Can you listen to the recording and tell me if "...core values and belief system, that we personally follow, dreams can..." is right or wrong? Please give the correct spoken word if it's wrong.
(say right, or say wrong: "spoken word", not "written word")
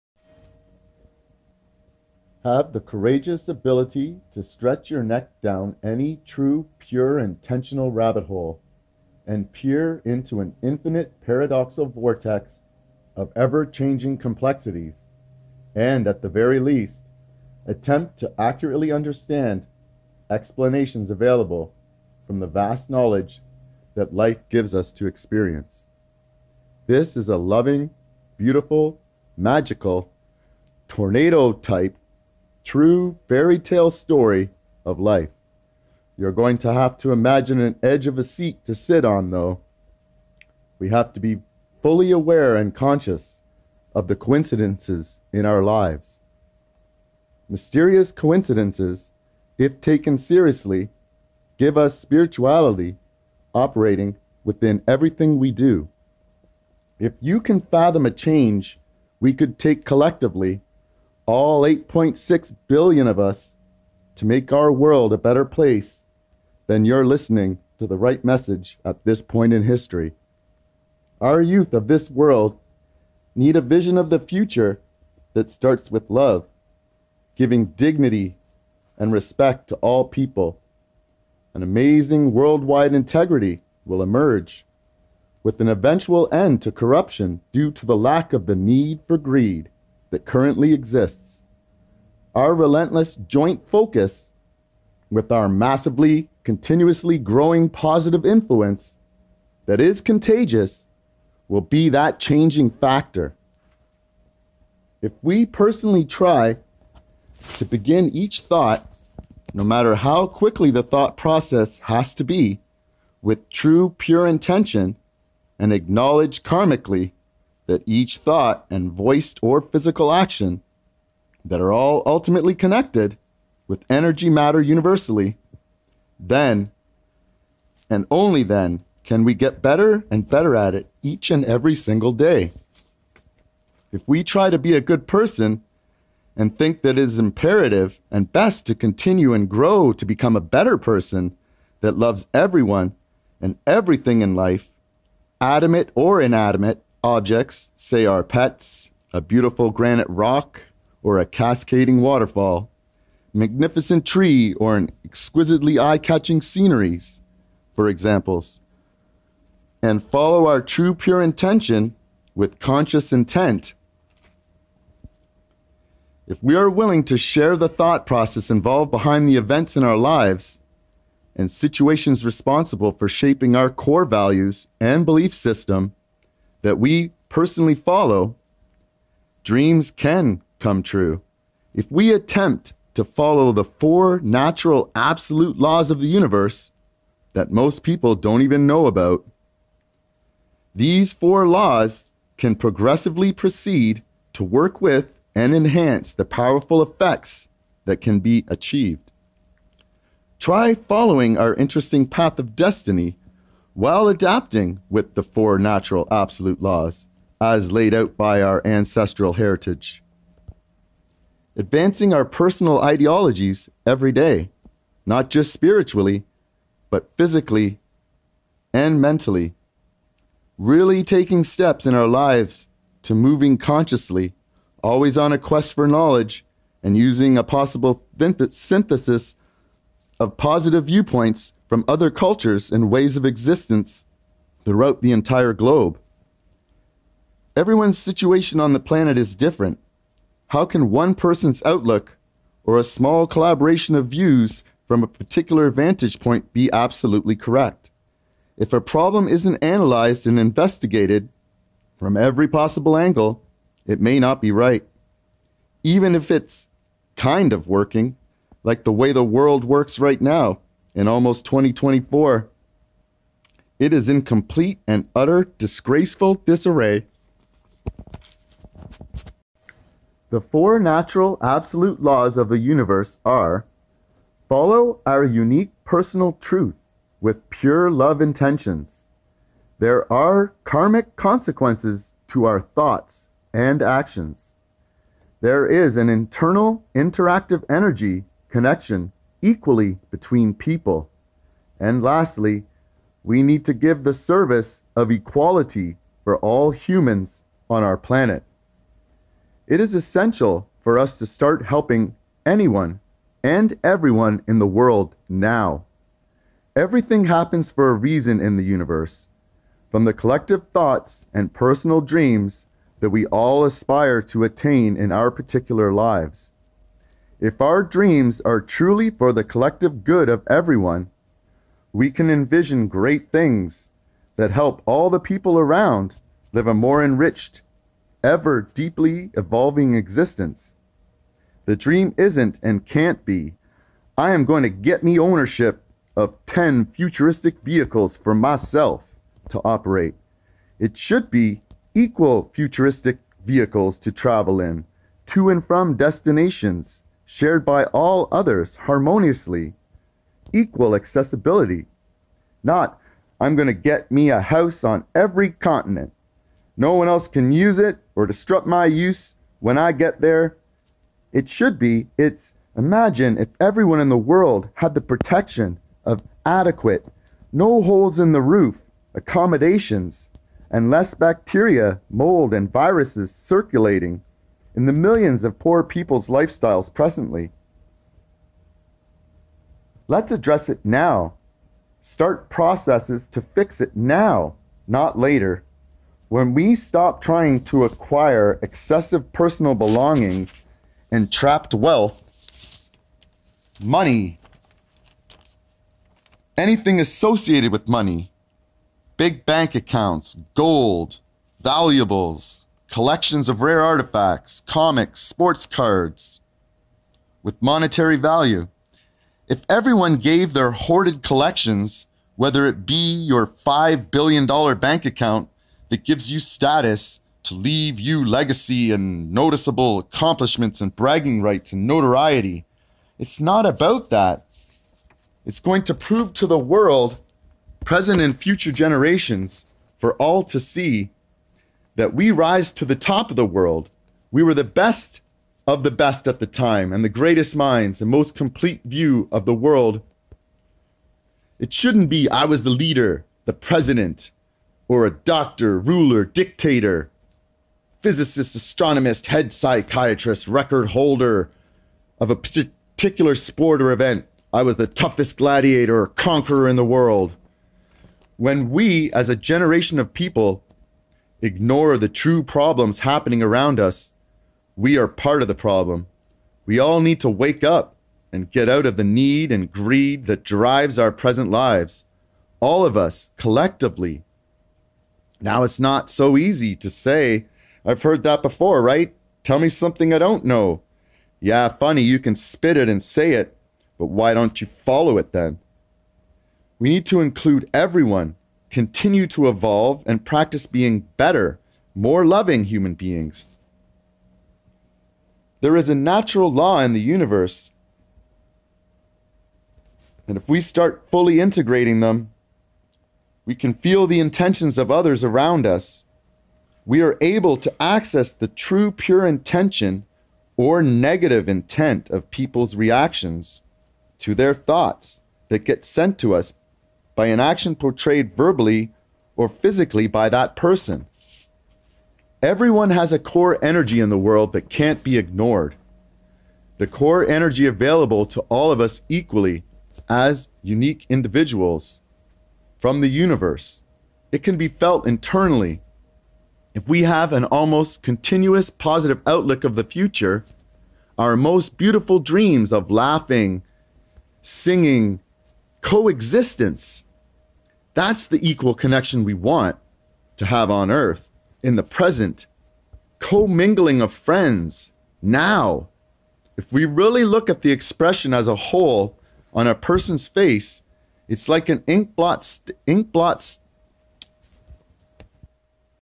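right.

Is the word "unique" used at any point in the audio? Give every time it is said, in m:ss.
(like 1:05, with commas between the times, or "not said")
4:35, 8:50.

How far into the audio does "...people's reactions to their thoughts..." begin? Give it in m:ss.
8:32.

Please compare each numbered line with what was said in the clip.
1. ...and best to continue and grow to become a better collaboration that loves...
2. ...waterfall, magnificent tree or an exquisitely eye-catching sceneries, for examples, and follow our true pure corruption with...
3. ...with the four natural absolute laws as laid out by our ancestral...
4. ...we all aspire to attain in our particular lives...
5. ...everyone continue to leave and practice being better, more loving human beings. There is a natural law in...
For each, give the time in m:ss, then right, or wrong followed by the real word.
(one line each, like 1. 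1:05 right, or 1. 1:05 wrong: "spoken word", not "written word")
1. 2:18 wrong: "person", not "collaboration"
2. 2:32 wrong: "intention", not "corruption"
3. 3:24 right
4. 5:13 right
5. 8:07 wrong: "evolve", not "leave".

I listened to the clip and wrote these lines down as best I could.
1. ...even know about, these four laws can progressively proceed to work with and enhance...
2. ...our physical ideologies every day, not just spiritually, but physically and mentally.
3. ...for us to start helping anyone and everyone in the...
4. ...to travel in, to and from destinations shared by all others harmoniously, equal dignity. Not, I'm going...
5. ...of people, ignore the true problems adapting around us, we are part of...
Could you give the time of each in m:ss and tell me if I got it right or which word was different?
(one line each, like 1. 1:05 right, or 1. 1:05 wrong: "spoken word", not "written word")
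1. 3:08 right
2. 3:32 wrong: "personal", not "physical"
3. 5:00 right
4. 5:43 wrong: "accessibility", not "dignity"
5. 7:39 wrong: "happening", not "adapting".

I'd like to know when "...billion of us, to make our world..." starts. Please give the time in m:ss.
1:02.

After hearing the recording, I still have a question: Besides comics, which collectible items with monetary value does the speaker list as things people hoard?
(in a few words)
sports cards.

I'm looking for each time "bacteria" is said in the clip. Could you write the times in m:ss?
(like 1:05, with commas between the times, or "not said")
6:11.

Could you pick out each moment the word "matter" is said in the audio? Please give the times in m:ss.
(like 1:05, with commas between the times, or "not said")
1:49, 2:04.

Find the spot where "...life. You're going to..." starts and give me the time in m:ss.
0:34.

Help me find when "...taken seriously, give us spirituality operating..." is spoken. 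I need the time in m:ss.
0:49.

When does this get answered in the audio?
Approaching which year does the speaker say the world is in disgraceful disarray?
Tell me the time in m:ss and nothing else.
4:21.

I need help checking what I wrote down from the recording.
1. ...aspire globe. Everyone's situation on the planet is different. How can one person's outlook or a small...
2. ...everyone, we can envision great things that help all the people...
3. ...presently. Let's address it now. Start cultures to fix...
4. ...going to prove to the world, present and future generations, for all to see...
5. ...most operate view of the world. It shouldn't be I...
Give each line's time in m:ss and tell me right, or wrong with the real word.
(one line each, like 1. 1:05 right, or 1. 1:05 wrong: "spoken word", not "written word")
1. 3:55 wrong: "entire", not "aspire"
2. 5:20 right
3. 6:16 wrong: "processes", not "cultures"
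4. 7:05 right
5. 7:18 wrong: "complete", not "operate".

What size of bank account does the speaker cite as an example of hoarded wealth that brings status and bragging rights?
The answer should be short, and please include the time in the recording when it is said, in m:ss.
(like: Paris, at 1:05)
$5 billion, at 6:53.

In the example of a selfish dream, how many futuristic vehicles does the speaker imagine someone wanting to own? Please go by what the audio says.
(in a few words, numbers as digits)
10.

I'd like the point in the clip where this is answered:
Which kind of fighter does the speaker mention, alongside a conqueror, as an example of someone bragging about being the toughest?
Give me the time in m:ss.
7:35.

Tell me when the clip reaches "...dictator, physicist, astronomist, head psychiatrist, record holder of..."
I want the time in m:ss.
7:26.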